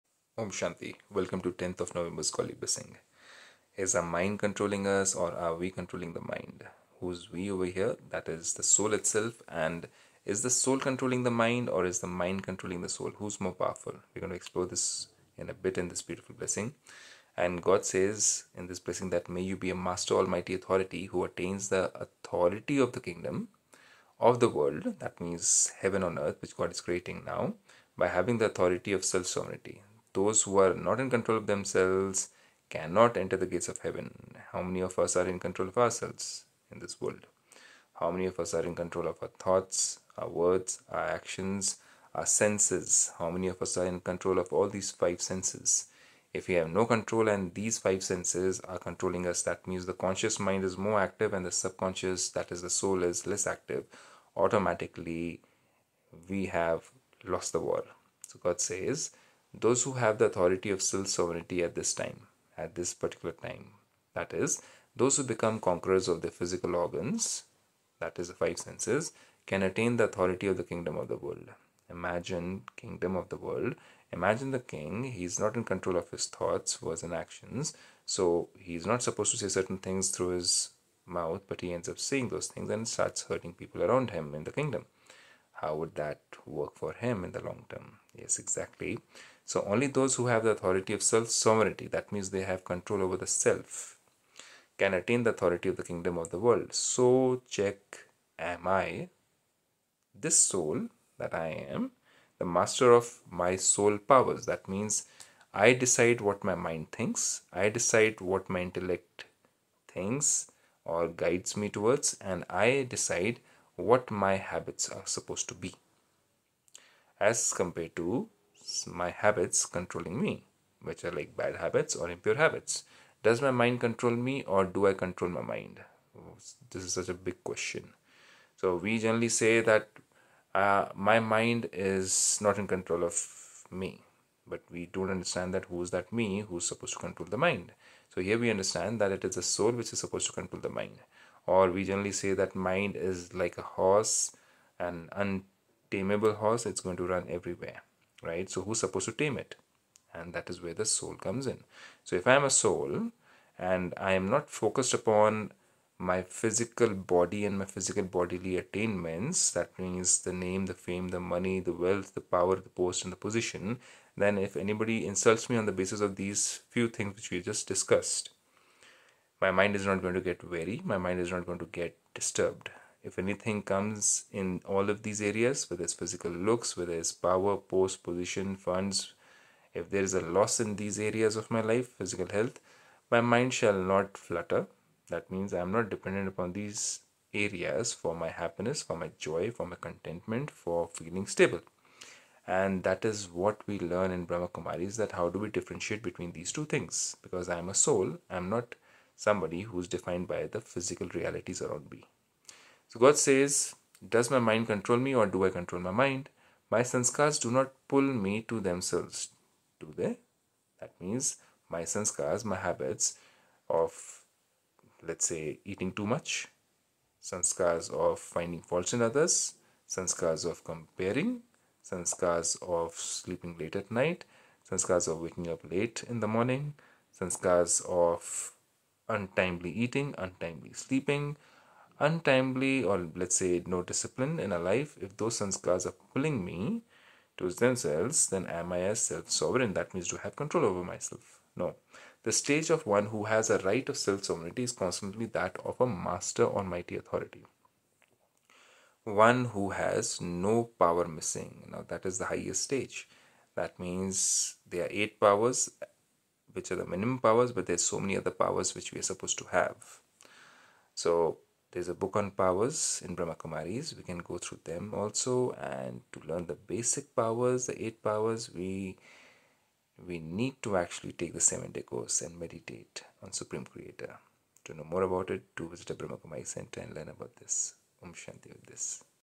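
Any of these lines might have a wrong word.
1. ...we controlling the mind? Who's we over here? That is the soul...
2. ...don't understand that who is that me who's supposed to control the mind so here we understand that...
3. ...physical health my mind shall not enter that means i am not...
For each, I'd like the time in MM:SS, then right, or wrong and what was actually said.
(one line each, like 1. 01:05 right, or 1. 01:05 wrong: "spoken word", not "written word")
1. 00:05 right
2. 02:14 right
3. 03:01 wrong: "flutter", not "enter".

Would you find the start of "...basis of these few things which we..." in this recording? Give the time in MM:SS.
02:45.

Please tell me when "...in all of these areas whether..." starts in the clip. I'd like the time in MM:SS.
02:54.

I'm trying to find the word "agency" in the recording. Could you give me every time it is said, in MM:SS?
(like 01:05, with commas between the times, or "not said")
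not said.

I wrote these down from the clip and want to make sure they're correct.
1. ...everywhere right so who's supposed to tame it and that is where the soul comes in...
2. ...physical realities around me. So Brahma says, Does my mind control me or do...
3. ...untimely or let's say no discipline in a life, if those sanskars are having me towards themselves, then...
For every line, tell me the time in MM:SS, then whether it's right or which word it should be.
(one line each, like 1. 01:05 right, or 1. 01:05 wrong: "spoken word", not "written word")
1. 02:27 right
2. 03:20 wrong: "God", not "Brahma"
3. 03:51 wrong: "pulling", not "having".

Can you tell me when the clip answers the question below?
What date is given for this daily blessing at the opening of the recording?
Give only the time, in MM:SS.
00:01.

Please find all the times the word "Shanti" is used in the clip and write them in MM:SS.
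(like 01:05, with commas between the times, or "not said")
00:00, 04:38.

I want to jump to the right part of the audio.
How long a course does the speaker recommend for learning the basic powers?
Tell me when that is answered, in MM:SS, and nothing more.
04:31.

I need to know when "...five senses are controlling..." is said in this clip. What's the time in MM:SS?
00:47.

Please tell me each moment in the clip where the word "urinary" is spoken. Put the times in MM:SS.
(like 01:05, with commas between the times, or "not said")
not said.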